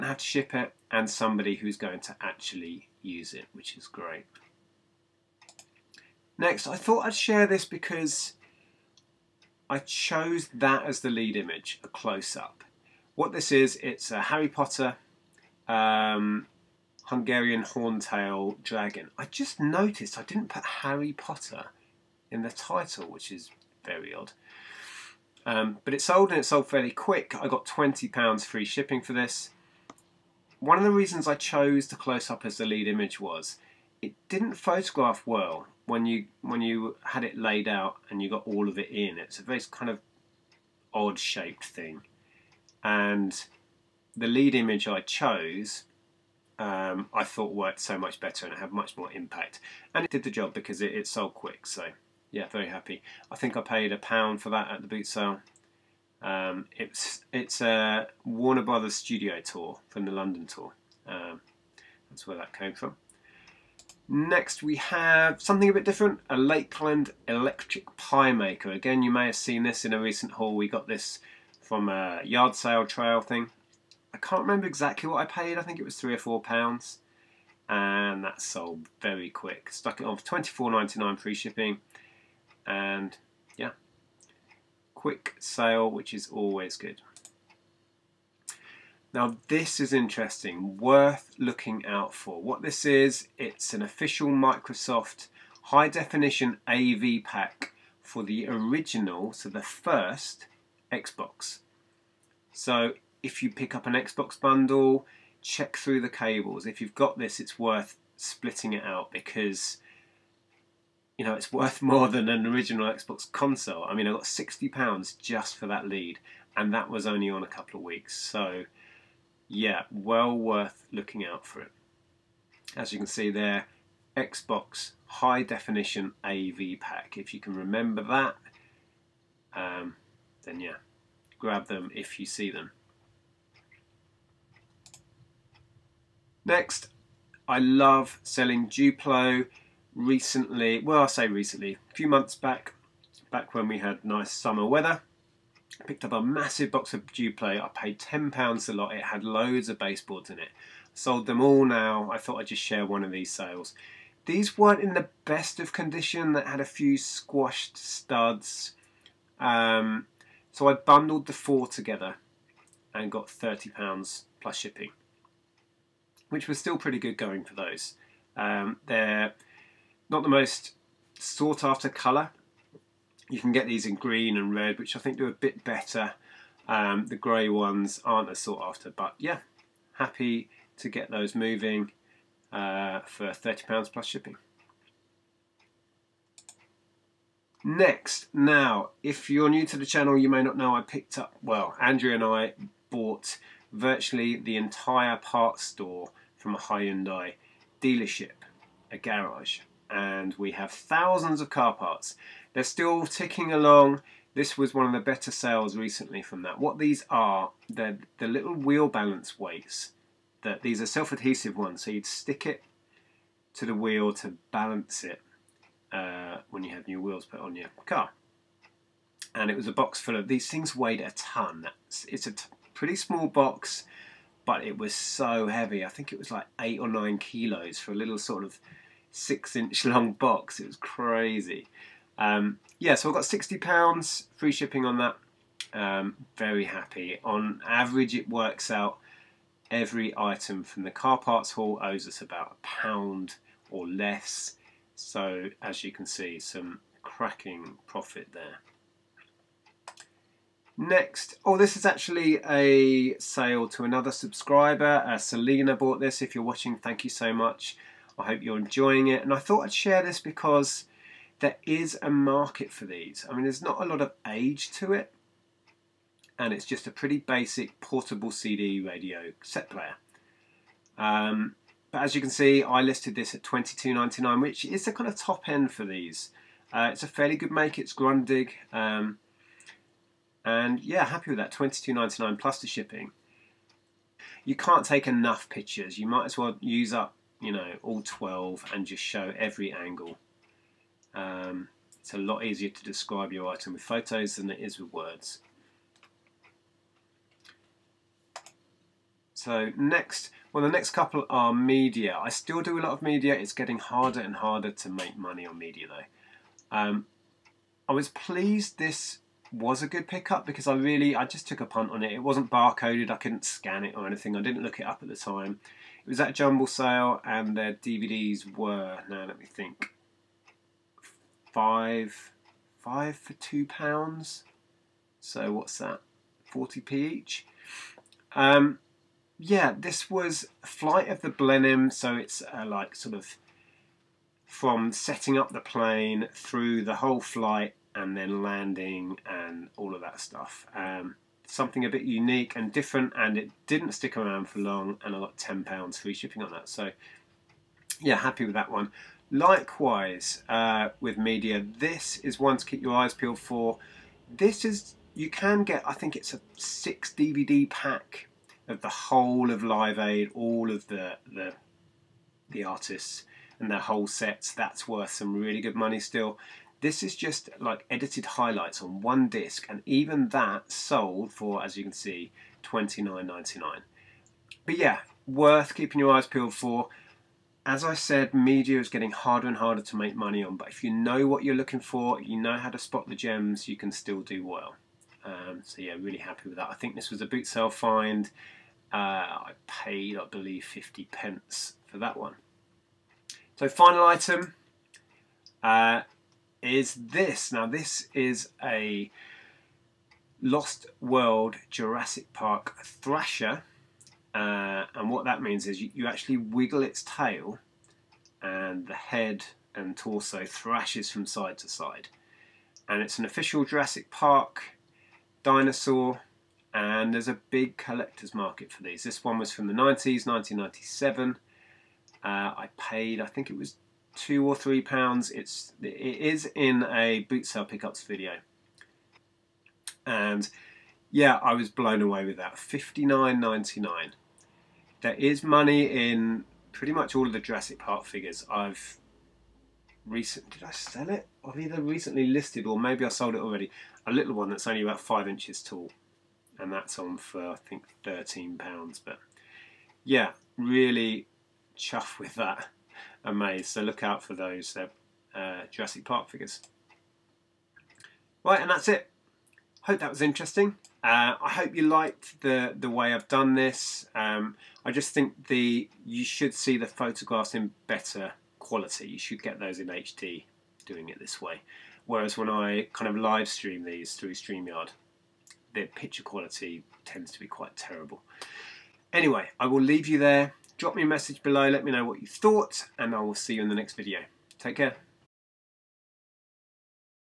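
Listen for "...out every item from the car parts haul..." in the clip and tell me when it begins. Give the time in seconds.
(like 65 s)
238 s.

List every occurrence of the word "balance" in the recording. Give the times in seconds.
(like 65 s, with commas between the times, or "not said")
208 s, 214 s.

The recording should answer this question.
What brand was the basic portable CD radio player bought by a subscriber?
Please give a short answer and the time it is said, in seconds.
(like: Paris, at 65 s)
Grundig, at 277 s.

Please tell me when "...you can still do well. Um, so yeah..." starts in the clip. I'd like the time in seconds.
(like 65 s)
383 s.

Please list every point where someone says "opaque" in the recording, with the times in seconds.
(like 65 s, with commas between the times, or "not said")
not said.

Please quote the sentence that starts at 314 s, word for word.
I didn't look it up at the time.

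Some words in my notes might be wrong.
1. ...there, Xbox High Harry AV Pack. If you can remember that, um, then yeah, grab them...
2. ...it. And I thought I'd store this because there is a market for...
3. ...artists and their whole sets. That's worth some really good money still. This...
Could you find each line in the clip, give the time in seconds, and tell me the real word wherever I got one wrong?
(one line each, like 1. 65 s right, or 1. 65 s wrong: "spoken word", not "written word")
1. 123 s wrong: "Definition", not "Harry"
2. 259 s wrong: "share", not "store"
3. 362 s right.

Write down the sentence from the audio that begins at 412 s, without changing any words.
And it's an official Jurassic Park dinosaur and there's a big collector's market for these.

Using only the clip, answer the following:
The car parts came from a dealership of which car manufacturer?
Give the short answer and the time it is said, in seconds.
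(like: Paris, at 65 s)
Hyundai, at 196 s.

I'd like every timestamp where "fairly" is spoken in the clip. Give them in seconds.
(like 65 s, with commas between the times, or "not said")
26 s, 277 s.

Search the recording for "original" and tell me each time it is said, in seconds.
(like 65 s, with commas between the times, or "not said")
98 s, 112 s.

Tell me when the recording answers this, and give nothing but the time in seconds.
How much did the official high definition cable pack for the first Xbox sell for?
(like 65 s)
114 s.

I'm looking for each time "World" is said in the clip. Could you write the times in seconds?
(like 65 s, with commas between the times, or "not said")
400 s.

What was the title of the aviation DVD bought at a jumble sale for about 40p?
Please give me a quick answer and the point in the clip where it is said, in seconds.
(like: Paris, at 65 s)
Flight of the Blenheim, at 330 s.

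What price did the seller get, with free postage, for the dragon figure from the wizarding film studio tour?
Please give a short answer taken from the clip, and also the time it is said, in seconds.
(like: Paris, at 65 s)
£20, at 27 s.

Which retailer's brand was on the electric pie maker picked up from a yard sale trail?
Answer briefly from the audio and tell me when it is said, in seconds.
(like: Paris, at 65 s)
Lakeland, at 66 s.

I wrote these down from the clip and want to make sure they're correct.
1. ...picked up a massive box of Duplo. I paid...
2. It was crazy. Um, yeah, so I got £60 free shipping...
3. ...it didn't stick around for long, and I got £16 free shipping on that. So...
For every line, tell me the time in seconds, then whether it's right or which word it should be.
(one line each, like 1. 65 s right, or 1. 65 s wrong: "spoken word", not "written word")
1. 145 s right
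2. 230 s right
3. 343 s wrong: "10", not "16".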